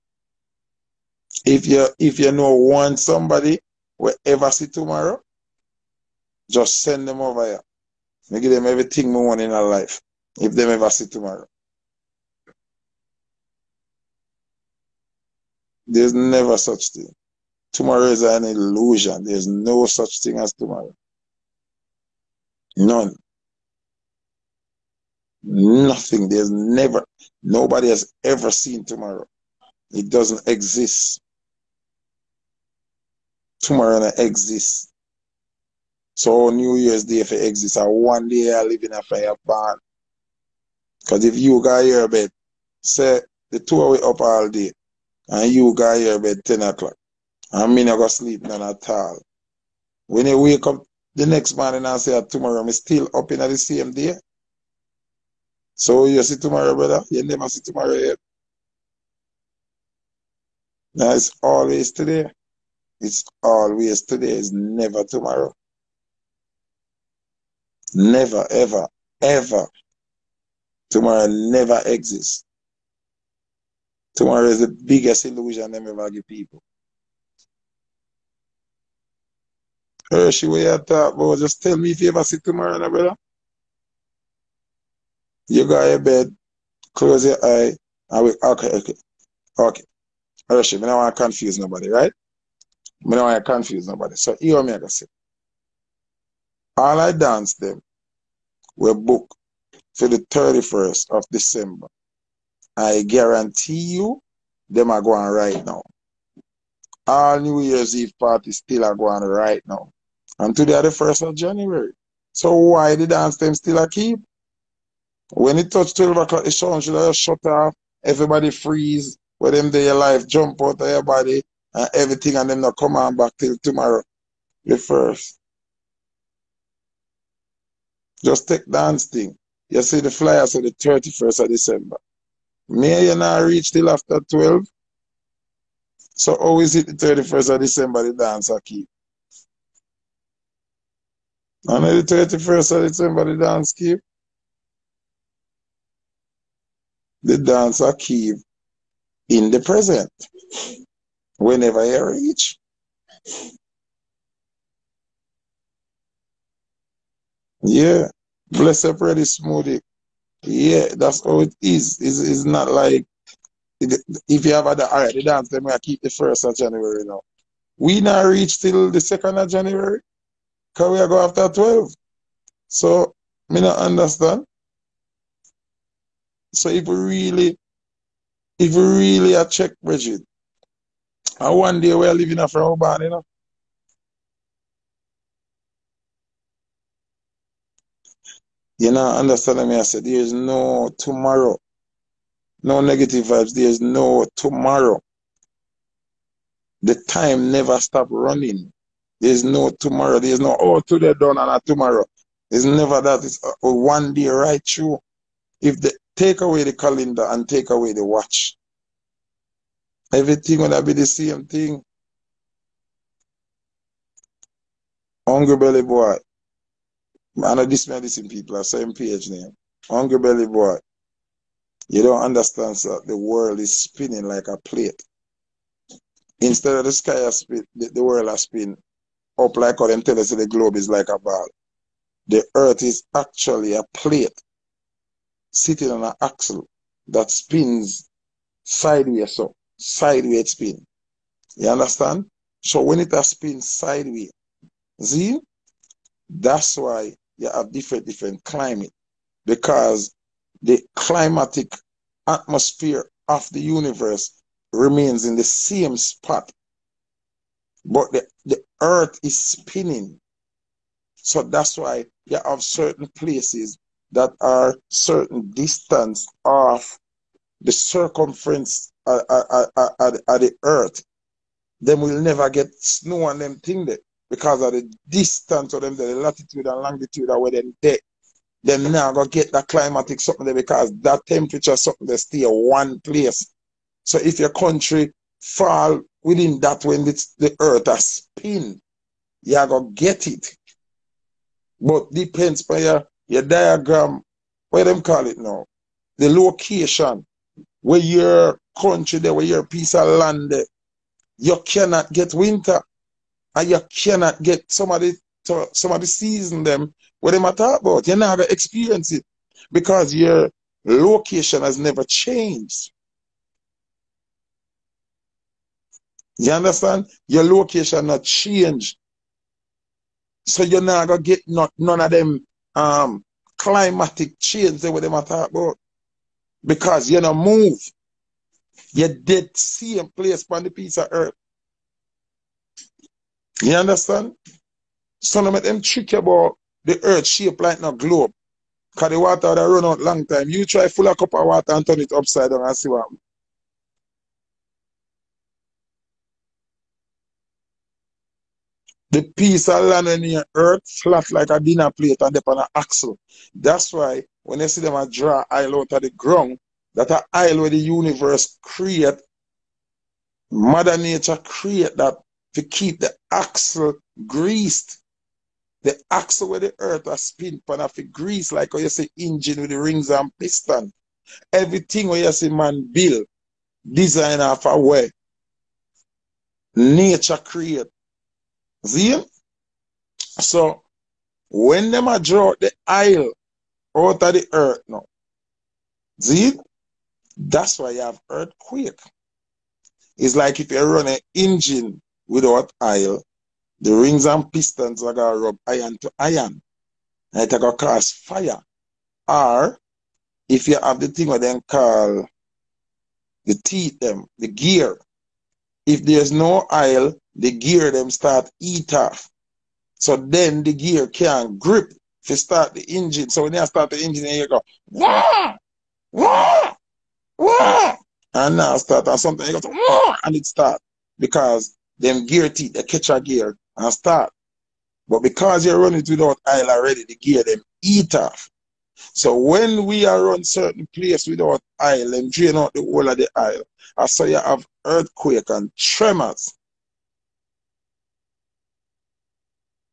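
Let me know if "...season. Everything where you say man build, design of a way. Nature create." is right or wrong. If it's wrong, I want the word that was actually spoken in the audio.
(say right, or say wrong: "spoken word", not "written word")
wrong: "piston", not "season".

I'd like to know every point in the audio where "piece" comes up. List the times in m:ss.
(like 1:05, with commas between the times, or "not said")
4:59, 5:30, 5:49.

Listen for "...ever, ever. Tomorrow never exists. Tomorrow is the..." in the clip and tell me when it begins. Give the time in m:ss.
1:08.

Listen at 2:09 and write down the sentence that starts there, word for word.
You see the flyer say the 31st of December.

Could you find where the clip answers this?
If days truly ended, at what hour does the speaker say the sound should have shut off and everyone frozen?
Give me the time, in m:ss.
1:55.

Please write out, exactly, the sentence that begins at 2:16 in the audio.
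So how is it the 31st of December the dance I keep?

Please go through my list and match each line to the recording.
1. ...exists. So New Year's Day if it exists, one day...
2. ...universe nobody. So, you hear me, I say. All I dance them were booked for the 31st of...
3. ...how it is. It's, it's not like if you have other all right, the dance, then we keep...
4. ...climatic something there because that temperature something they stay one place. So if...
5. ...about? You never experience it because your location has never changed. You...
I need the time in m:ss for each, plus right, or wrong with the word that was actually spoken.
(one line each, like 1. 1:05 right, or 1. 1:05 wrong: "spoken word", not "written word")
1. 0:34 right
2. 1:33 wrong: "confuse", not "universe"
3. 2:41 right
4. 4:39 right
5. 5:07 right.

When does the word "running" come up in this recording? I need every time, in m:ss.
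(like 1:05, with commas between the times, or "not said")
3:18, 7:05.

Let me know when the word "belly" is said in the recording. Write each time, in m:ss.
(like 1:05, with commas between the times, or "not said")
3:35, 3:40.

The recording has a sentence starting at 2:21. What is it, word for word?
And the 31st of December the dance keep?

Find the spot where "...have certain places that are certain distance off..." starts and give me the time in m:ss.
4:22.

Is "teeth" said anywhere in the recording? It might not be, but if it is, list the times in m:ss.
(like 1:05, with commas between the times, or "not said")
6:43, 7:02.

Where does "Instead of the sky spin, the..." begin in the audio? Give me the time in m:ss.
3:46.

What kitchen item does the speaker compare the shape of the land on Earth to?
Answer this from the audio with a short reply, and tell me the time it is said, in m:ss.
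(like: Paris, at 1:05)
dinner plate, at 5:51.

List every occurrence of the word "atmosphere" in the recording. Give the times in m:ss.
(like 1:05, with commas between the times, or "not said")
4:12.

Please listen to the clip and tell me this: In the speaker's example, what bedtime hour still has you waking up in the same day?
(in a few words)
10 o'clock.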